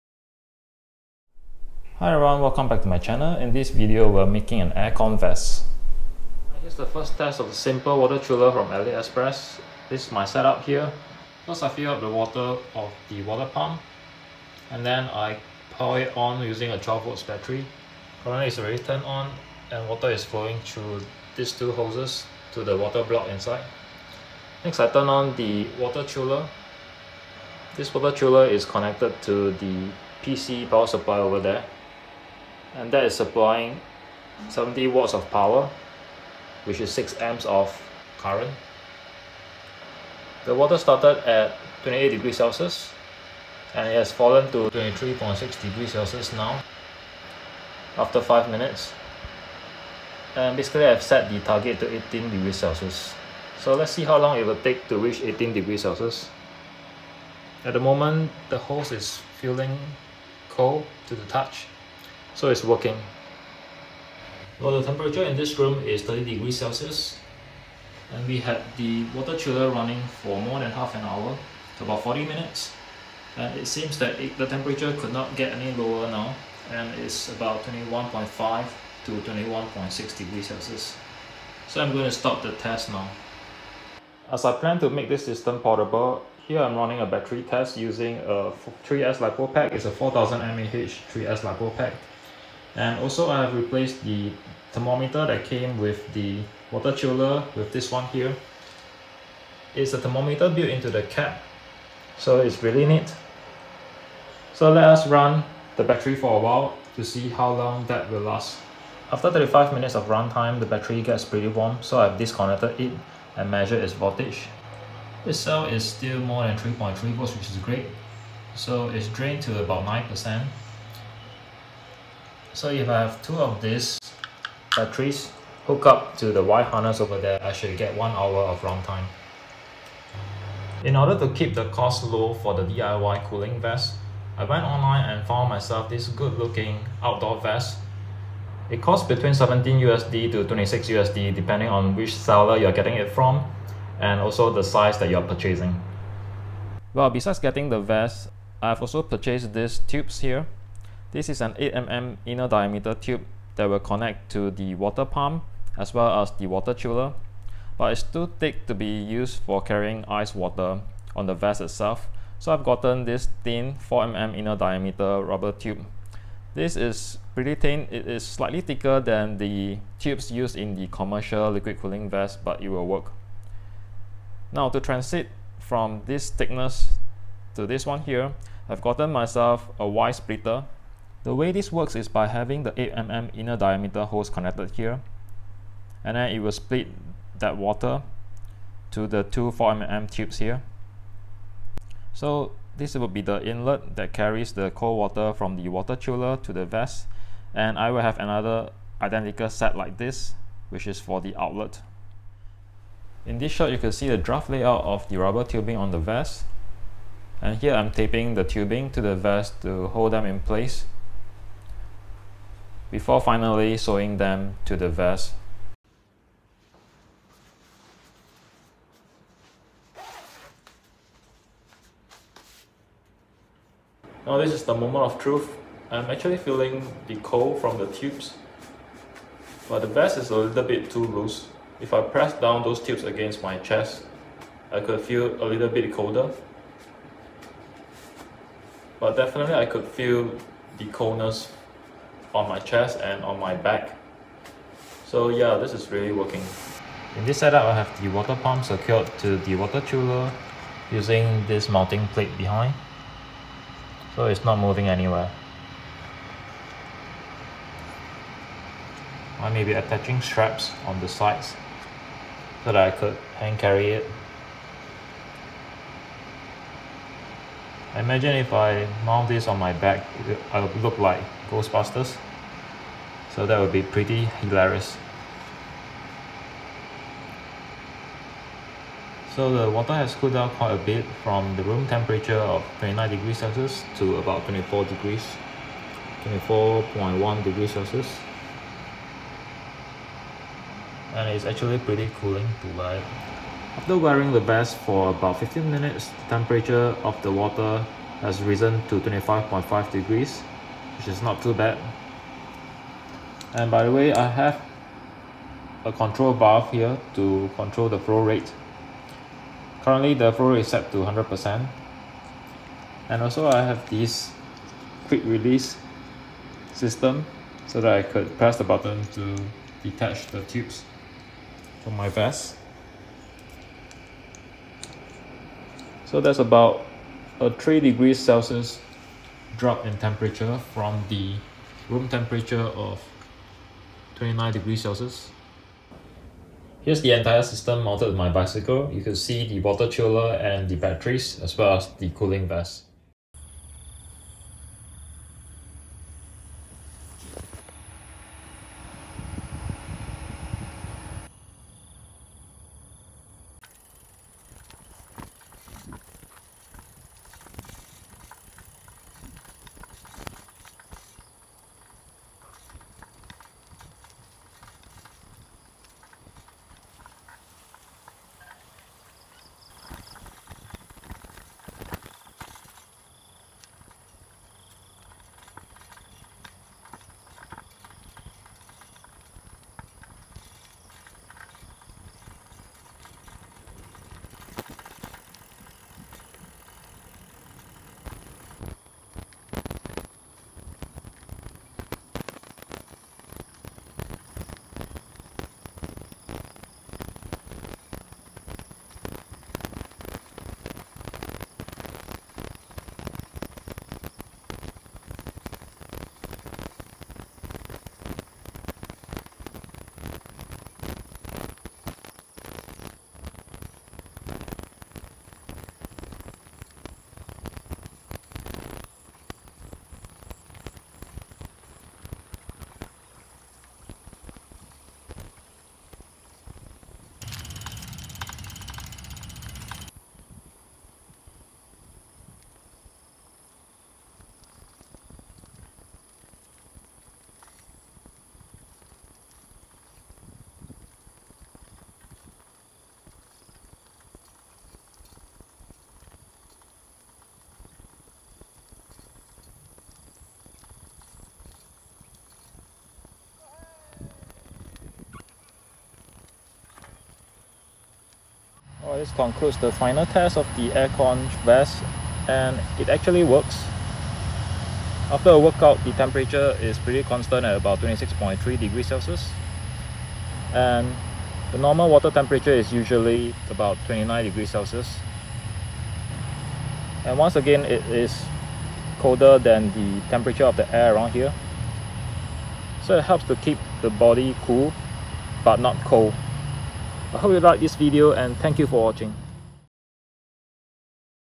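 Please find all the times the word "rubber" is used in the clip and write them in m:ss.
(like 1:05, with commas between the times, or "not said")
2:45, 3:25.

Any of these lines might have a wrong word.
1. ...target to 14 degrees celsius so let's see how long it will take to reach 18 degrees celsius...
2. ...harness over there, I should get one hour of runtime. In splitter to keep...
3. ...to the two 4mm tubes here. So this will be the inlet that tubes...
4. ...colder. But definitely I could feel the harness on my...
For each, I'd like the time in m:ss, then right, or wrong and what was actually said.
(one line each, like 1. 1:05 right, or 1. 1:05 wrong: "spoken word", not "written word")
1. 0:51 wrong: "18", not "14"
2. 2:06 wrong: "order", not "splitter"
3. 3:08 wrong: "carries", not "tubes"
4. 3:55 wrong: "coldness", not "harness".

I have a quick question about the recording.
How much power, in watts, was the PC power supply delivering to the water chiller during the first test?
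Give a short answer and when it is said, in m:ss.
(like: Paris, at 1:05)
70 watts, at 0:34.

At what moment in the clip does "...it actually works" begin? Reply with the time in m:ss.
7:42.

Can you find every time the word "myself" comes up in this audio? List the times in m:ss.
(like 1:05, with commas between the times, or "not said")
2:15, 2:59.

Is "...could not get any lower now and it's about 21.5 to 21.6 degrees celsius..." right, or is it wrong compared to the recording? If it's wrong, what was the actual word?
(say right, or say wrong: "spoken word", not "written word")
right.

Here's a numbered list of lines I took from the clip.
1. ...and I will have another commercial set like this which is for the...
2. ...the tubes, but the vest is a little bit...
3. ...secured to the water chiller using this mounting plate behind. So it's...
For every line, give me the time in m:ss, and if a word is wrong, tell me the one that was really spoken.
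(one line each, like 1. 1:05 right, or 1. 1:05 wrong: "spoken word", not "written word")
1. 3:17 wrong: "identical", not "commercial"
2. 3:47 right
3. 4:08 right.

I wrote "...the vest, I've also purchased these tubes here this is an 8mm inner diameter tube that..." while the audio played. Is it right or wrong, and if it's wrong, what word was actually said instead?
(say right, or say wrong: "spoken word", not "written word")
right.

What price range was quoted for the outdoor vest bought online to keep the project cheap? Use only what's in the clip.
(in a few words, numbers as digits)
17 to 26 USD.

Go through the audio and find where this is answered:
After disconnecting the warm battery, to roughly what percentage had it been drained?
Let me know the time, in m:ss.
1:59.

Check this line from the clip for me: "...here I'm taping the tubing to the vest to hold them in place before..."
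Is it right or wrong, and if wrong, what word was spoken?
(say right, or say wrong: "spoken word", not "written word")
right.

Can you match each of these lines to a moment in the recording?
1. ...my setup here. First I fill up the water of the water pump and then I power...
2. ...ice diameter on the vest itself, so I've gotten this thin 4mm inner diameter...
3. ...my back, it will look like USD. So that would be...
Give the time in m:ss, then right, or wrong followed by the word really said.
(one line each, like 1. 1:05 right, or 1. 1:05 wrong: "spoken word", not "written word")
1. 0:10 right
2. 2:40 wrong: "water", not "diameter"
3. 4:29 wrong: "Ghostbusters", not "USD".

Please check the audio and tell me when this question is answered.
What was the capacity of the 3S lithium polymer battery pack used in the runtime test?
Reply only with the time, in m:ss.
1:29.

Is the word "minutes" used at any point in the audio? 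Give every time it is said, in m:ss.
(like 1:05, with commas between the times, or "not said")
0:48, 1:12, 1:49, 4:55.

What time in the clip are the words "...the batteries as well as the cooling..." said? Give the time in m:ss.
5:40.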